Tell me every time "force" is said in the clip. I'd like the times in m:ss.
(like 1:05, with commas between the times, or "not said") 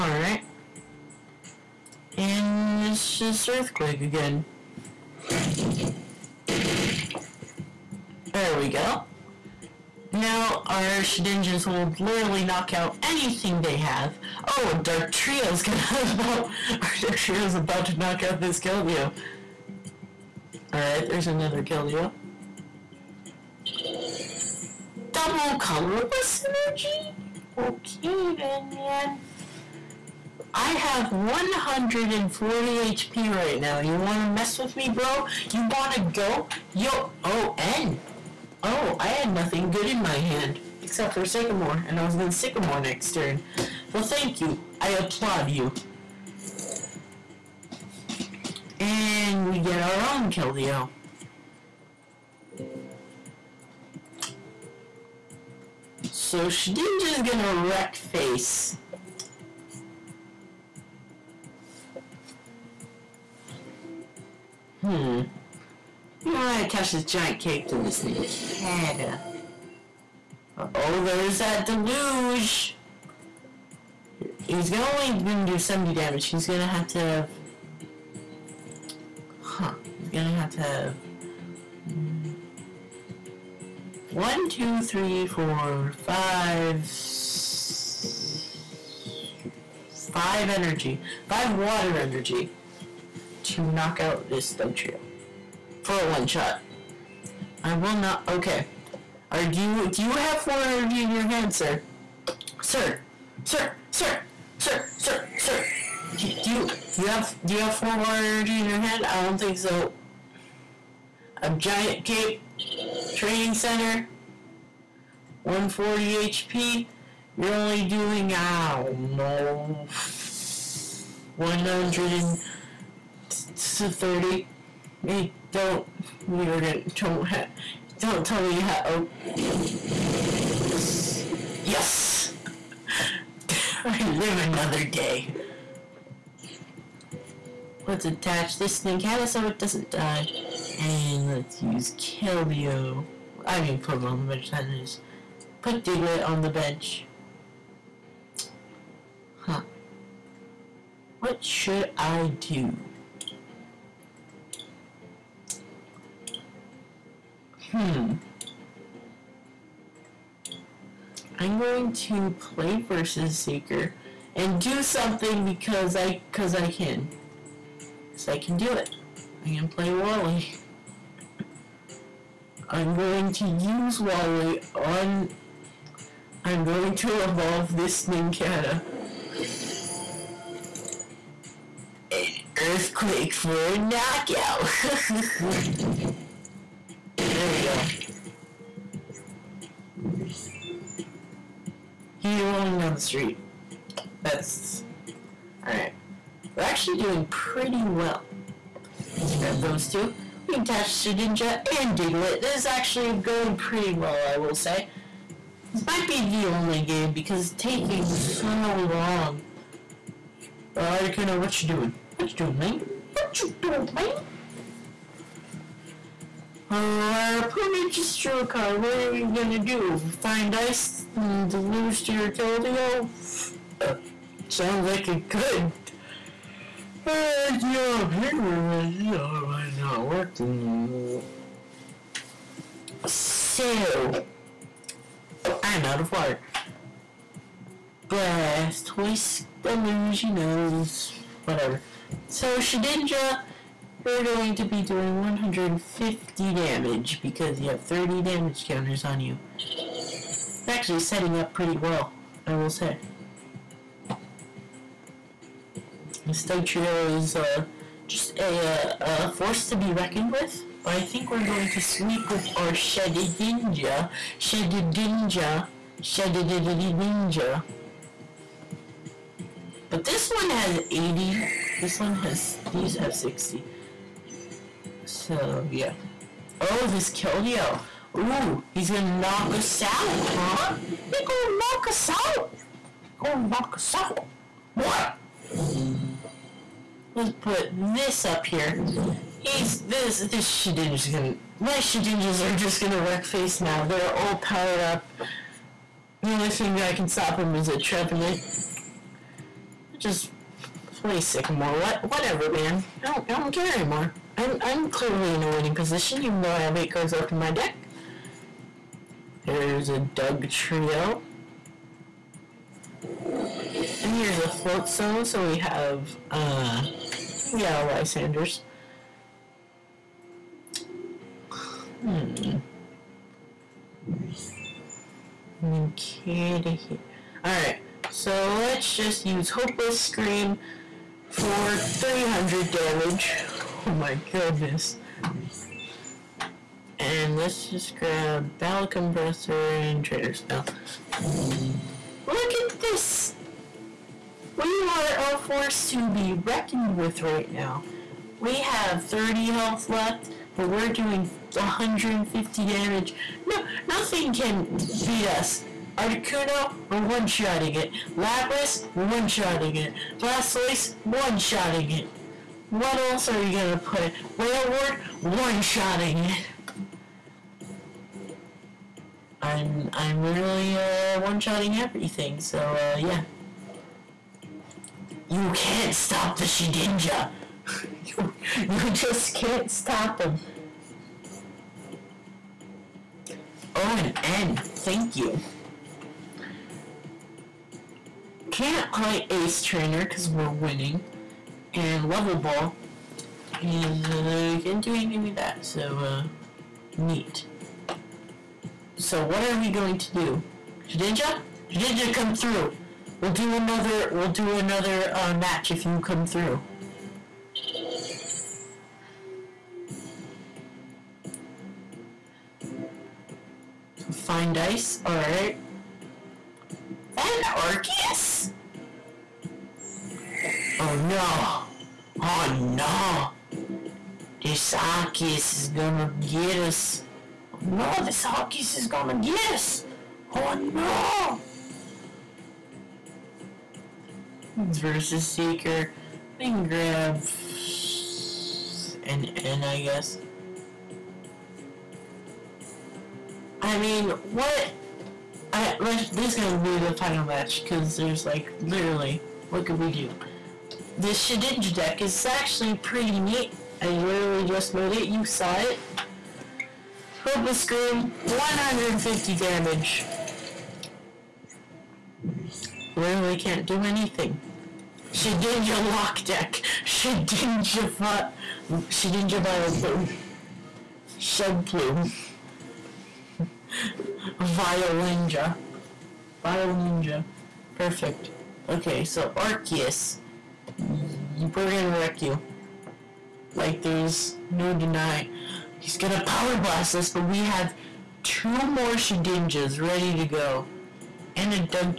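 4:19, 5:45.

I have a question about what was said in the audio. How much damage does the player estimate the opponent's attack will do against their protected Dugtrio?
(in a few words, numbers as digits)
130.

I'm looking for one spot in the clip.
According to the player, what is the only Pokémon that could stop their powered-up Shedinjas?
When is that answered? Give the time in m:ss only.
4:57.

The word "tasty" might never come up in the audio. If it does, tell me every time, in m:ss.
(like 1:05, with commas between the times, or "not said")
not said.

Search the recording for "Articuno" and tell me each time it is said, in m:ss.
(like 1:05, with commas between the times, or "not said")
3:30, 5:55.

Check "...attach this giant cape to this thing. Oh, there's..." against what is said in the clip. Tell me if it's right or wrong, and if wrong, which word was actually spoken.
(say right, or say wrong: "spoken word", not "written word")
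right.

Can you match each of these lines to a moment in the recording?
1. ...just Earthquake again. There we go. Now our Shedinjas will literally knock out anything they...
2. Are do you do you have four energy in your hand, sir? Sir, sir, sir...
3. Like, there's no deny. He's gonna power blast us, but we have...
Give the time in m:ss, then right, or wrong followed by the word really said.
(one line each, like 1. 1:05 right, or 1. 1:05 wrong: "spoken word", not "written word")
1. 0:03 right
2. 1:39 right
3. 8:03 right.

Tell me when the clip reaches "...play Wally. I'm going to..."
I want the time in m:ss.
2:49.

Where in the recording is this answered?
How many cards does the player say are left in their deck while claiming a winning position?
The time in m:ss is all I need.
5:06.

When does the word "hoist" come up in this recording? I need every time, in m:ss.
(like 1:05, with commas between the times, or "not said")
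3:58.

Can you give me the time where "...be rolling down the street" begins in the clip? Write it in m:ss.
3:12.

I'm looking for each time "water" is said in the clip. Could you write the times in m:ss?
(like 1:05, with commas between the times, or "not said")
1:31, 1:47, 3:56.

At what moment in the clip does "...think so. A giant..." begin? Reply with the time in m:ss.
1:49.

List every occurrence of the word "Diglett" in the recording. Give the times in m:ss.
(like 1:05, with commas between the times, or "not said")
2:25, 3:21.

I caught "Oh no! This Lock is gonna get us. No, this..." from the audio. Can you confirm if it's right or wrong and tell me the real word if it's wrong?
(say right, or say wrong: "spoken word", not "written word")
wrong: "Arceus", not "Lock".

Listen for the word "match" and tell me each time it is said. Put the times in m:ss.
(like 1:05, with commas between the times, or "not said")
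6:45, 7:27.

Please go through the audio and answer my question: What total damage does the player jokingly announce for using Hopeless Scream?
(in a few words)
300.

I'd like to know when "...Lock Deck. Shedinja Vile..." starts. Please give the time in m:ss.
7:45.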